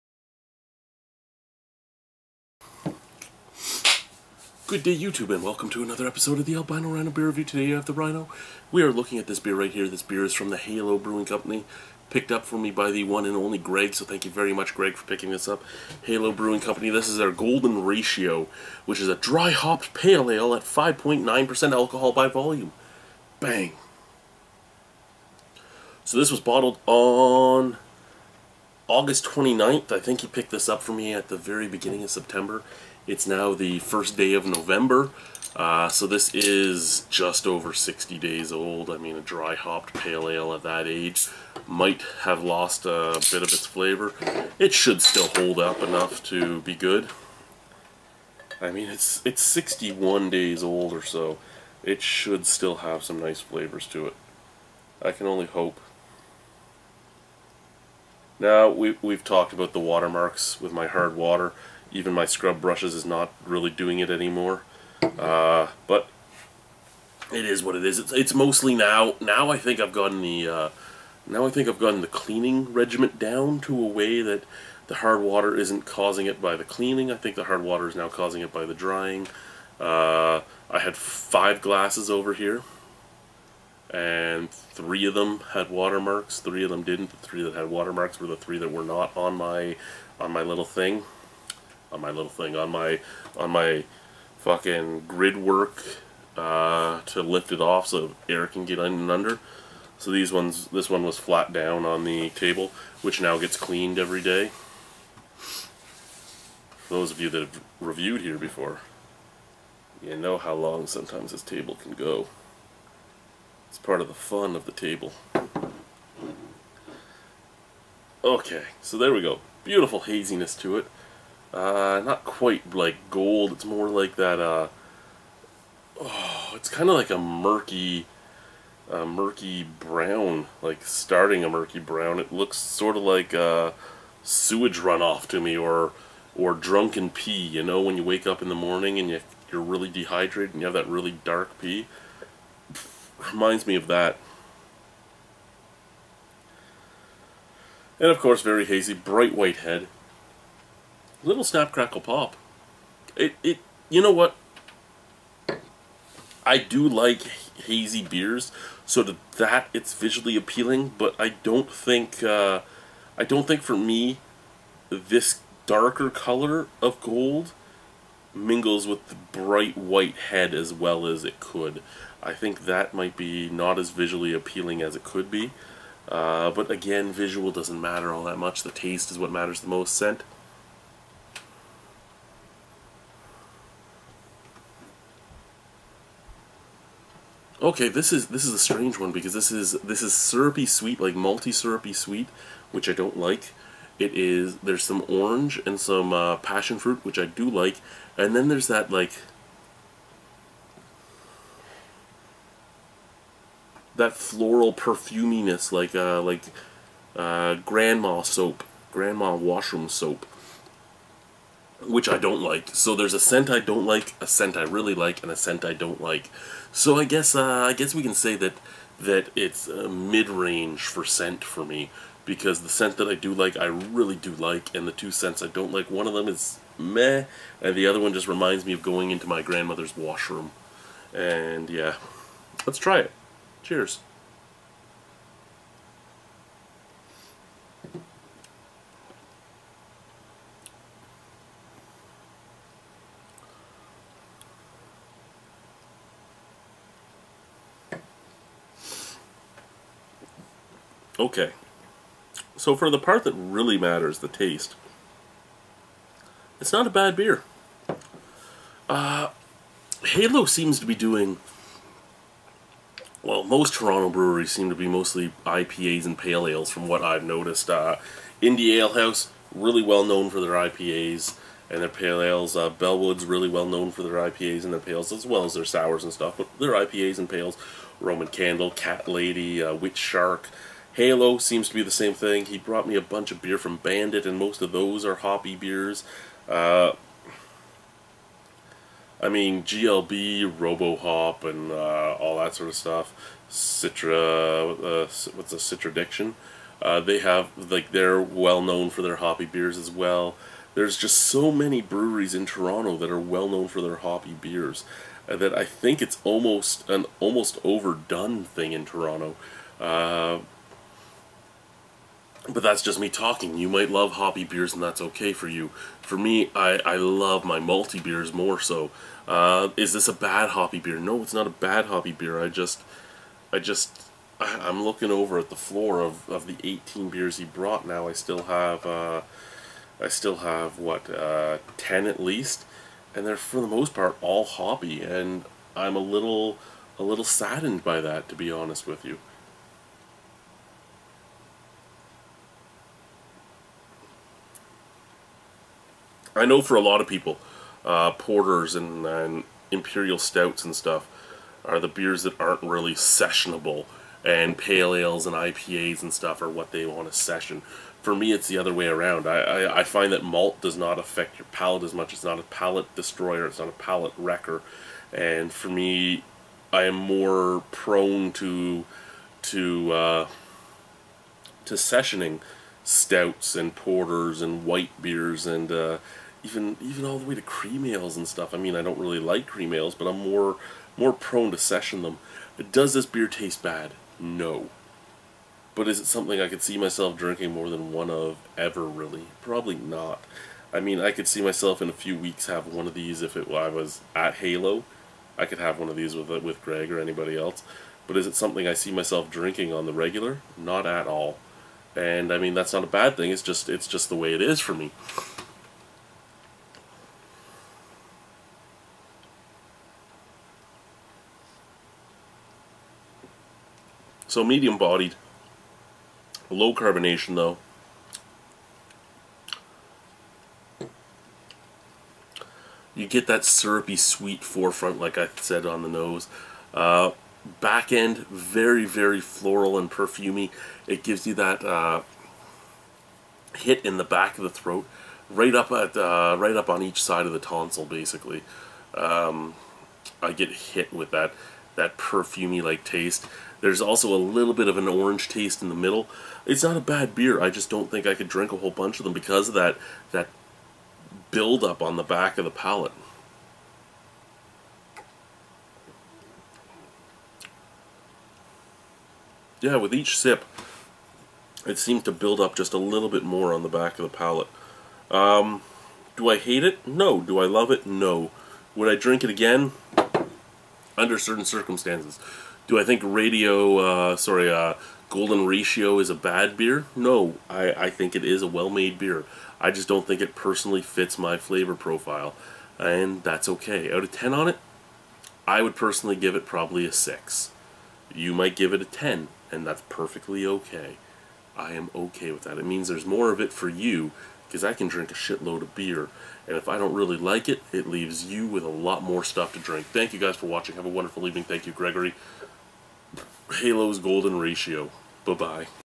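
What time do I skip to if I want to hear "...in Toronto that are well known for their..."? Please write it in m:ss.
5:02.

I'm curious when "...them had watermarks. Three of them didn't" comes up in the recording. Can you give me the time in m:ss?
1:25.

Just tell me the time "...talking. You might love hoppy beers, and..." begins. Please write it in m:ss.
5:13.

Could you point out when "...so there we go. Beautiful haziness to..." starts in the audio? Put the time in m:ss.
1:58.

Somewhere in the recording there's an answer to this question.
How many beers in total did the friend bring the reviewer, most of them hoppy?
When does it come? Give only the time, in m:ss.
5:26.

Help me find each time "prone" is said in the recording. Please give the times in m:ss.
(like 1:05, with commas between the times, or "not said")
6:07, 6:21.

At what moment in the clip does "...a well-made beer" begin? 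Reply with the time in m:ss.
7:58.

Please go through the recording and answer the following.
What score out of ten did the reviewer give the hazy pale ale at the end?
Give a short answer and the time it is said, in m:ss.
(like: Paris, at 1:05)
6, at 8:06.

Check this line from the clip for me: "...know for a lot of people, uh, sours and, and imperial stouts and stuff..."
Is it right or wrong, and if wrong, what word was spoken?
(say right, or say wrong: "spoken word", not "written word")
wrong: "porters", not "sours".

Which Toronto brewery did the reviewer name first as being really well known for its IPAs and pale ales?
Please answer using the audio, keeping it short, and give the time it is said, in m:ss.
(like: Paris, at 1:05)
Indie Ale House, at 4:28.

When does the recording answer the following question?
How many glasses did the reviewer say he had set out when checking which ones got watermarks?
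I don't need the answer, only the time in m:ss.
1:20.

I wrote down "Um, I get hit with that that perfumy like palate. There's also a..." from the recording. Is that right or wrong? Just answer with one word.
wrong.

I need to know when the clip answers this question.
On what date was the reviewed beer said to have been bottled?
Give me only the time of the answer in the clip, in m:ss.
0:28.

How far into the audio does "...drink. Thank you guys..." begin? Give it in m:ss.
8:19.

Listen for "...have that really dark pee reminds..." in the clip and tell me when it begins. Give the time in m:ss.
2:20.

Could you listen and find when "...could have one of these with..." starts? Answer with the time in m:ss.
6:35.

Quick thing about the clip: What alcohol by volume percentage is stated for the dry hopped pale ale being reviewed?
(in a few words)
5.9%.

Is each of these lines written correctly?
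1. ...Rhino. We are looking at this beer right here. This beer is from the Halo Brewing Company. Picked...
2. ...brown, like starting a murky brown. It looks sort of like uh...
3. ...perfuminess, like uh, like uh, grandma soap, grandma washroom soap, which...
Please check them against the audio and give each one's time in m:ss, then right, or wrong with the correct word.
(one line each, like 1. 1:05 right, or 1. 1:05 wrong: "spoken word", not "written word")
1. 0:07 right
2. 2:09 right
3. 3:24 right.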